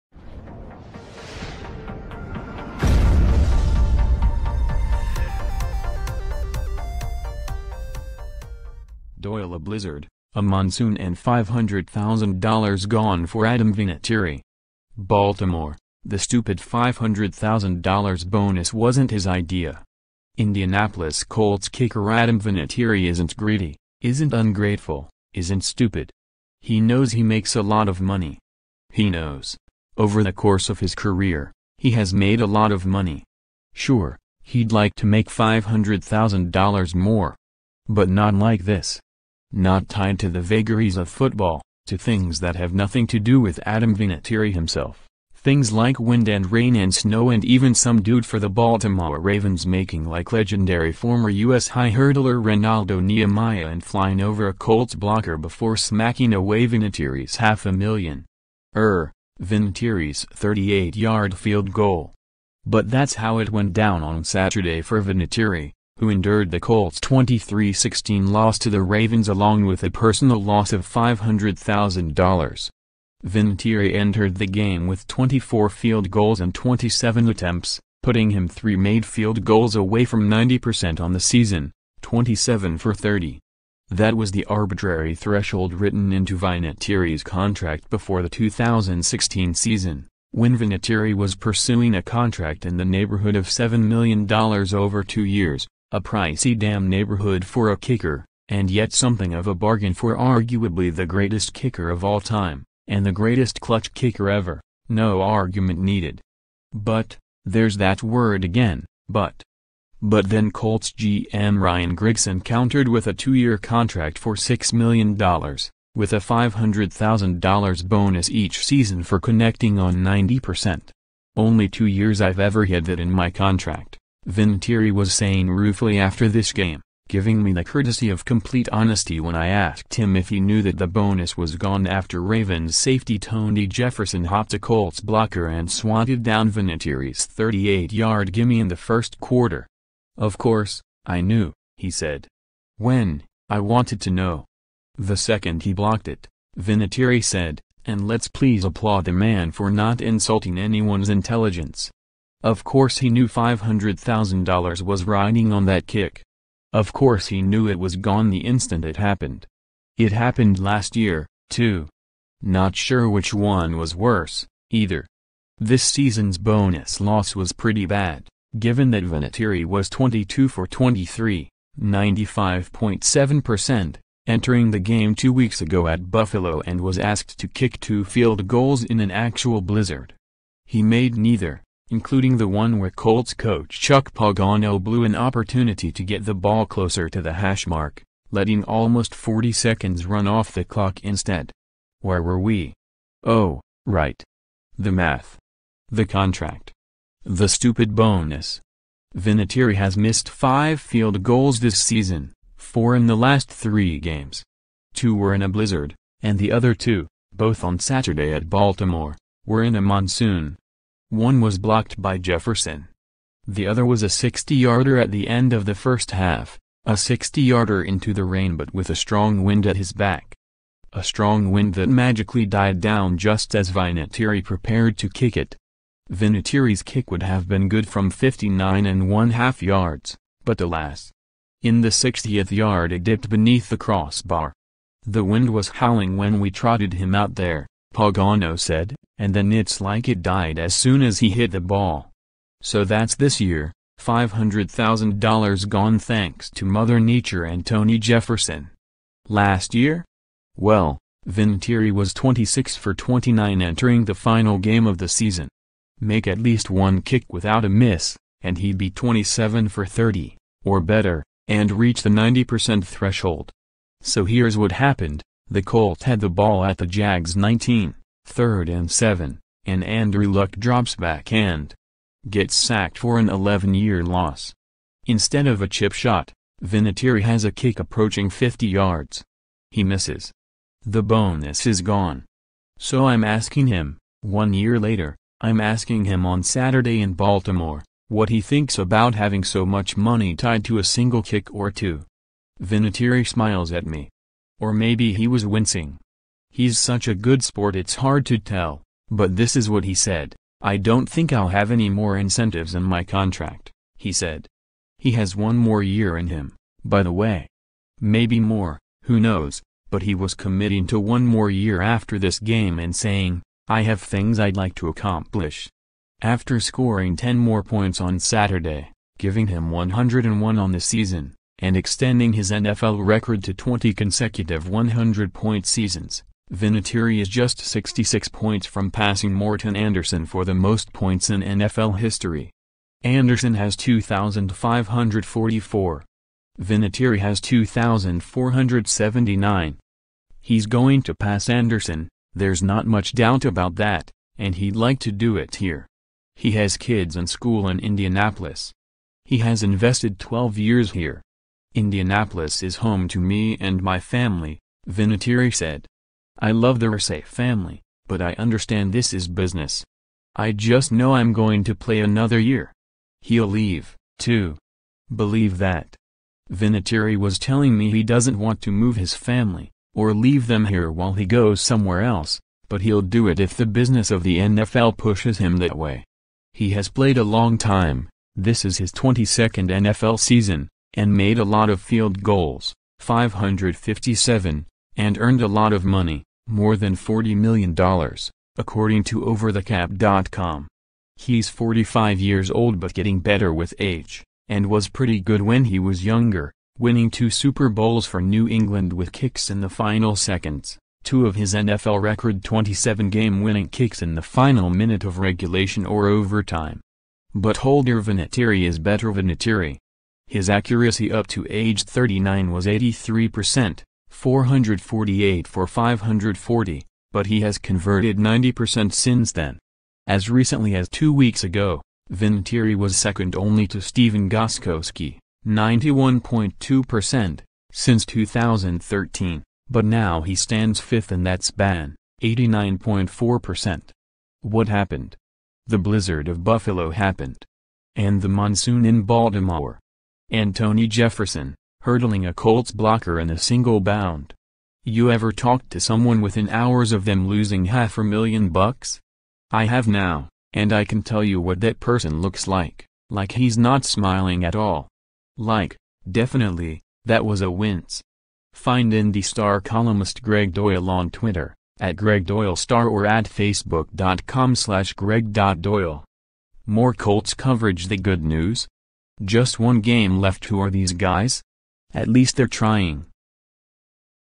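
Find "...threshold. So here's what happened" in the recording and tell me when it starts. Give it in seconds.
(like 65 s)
262 s.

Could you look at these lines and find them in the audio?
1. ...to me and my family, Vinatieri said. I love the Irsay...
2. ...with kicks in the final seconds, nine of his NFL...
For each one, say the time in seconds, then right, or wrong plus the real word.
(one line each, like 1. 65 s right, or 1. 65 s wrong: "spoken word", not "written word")
1. 353 s right
2. 398 s wrong: "two", not "nine".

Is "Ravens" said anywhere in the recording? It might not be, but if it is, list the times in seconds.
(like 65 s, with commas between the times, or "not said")
49 s, 68 s, 132 s.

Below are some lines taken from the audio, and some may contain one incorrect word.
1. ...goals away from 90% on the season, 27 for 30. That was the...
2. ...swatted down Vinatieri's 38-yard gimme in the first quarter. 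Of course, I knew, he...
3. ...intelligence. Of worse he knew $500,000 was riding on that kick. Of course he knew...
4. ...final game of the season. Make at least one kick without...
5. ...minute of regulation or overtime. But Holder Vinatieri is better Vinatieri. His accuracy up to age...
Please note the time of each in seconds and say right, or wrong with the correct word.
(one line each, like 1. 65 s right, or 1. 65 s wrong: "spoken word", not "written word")
1. 79 s right
2. 135 s right
3. 151 s wrong: "course", not "worse"
4. 254 s right
5. 404 s right.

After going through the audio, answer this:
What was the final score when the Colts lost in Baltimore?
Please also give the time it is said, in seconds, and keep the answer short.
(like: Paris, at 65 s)
23-16, at 66 s.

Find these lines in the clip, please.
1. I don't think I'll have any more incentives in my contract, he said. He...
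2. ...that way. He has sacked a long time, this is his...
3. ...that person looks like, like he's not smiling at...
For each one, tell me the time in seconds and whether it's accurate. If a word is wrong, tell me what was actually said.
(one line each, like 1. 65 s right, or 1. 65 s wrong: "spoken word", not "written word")
1. 300 s right
2. 375 s wrong: "played", not "sacked"
3. 451 s right.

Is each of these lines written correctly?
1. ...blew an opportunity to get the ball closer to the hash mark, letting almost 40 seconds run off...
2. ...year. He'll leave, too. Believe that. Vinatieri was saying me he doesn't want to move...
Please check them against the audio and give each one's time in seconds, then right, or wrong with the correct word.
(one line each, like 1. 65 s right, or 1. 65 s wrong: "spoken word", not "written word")
1. 184 s right
2. 362 s wrong: "telling", not "saying".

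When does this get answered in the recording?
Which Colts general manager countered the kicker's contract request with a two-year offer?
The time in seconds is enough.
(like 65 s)
111 s.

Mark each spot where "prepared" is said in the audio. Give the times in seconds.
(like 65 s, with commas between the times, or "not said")
224 s.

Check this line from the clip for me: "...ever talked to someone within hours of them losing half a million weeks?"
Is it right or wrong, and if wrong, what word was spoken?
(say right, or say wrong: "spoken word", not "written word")
wrong: "bucks", not "weeks".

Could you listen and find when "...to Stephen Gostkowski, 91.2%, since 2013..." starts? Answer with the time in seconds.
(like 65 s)
423 s.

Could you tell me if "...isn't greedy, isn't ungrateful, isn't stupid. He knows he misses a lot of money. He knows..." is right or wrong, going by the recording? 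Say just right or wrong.
wrong.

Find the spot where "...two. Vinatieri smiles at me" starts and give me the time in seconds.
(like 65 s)
291 s.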